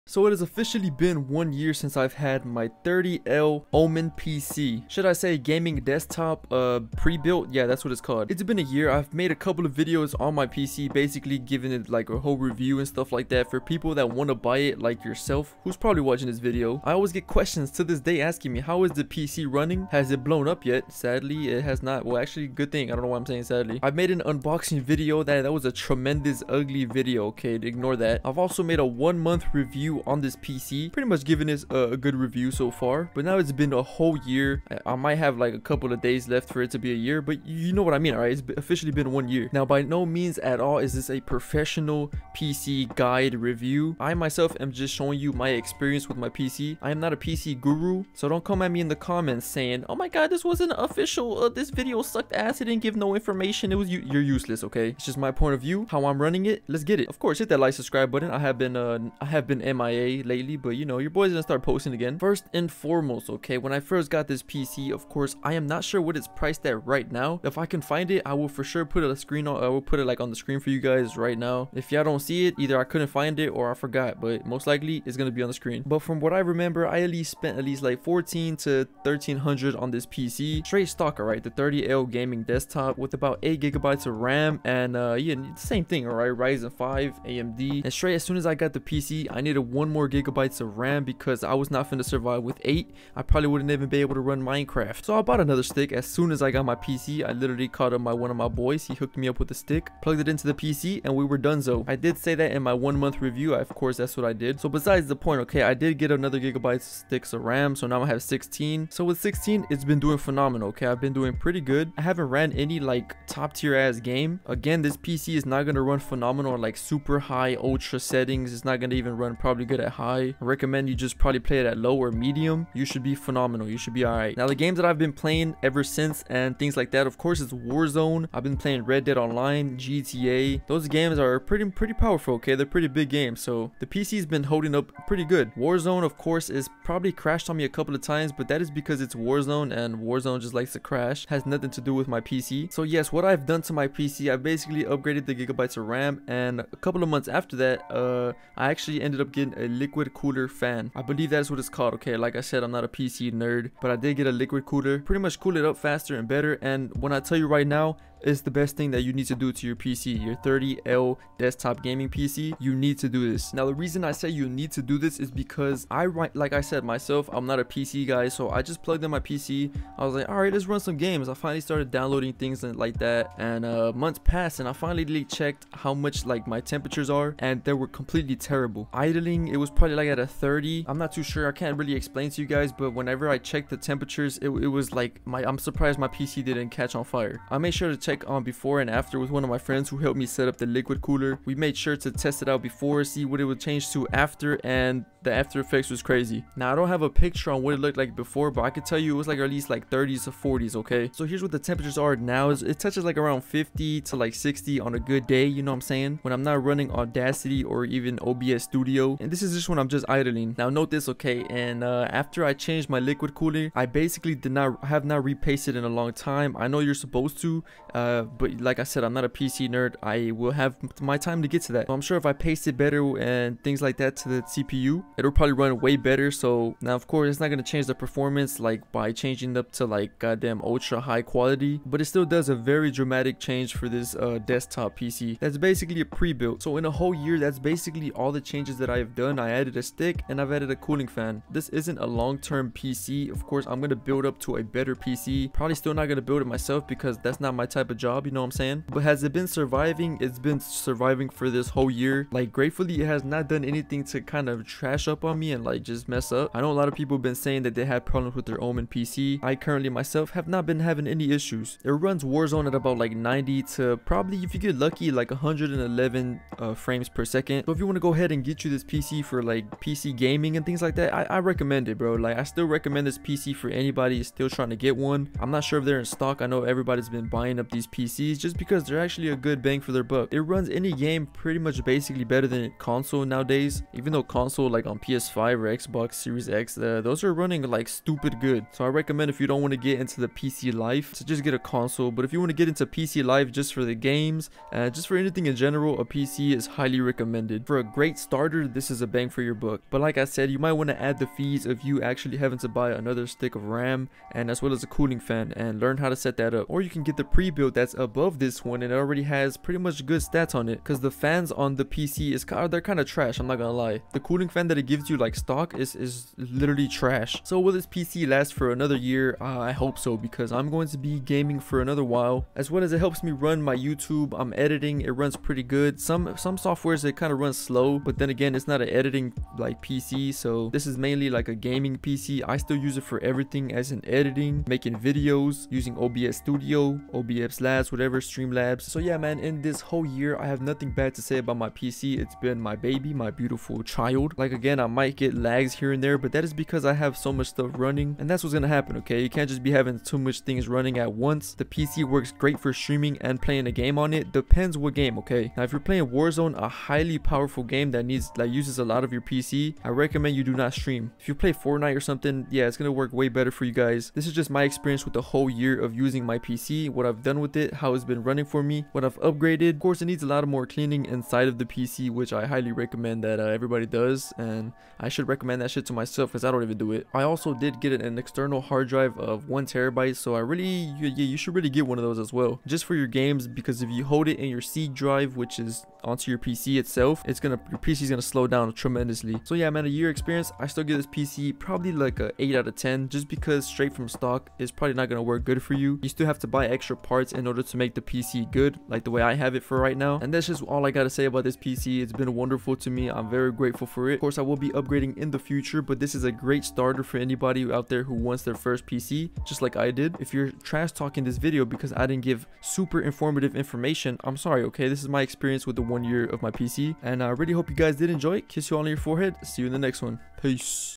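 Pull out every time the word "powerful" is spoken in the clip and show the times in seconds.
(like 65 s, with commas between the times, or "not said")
131 s, 357 s.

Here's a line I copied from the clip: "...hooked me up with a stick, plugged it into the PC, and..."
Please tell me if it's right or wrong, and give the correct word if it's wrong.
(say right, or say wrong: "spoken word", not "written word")
right.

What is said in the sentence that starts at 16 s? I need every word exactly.
I always get questions to this day asking me, how is the PC running?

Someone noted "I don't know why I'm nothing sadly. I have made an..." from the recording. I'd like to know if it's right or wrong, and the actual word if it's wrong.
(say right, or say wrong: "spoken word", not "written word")
wrong: "saying", not "nothing".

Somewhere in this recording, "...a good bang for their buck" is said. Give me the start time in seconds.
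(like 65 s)
279 s.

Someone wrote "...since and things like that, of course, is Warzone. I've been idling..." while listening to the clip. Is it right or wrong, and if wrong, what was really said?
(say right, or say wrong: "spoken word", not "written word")
wrong: "playing", not "idling".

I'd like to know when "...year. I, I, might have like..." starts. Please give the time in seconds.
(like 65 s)
34 s.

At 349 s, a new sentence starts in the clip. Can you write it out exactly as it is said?
You can't just be having too much things running at once.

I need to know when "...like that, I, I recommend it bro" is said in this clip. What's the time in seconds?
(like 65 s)
270 s.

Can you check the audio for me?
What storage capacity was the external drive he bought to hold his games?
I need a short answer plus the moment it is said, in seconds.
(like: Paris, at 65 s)
1 terabyte, at 379 s.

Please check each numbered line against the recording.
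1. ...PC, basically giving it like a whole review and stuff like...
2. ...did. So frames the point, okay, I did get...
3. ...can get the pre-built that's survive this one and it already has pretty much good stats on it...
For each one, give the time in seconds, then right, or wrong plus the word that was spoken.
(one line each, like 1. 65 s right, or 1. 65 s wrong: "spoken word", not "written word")
1. 10 s right
2. 104 s wrong: "besides", not "frames"
3. 306 s wrong: "above", not "survive".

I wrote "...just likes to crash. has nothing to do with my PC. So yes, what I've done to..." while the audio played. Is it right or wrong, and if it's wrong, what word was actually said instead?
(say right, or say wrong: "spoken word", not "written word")
right.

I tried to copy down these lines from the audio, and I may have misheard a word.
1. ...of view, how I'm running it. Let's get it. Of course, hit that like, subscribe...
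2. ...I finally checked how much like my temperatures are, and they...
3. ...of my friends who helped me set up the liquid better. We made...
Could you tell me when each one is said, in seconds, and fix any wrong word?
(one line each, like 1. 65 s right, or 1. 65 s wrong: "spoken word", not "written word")
1. 55 s right
2. 174 s right
3. 189 s wrong: "cooler", not "better".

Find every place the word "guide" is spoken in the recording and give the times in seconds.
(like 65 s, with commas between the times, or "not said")
42 s.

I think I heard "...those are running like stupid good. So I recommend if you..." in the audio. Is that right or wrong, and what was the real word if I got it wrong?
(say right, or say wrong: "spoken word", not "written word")
right.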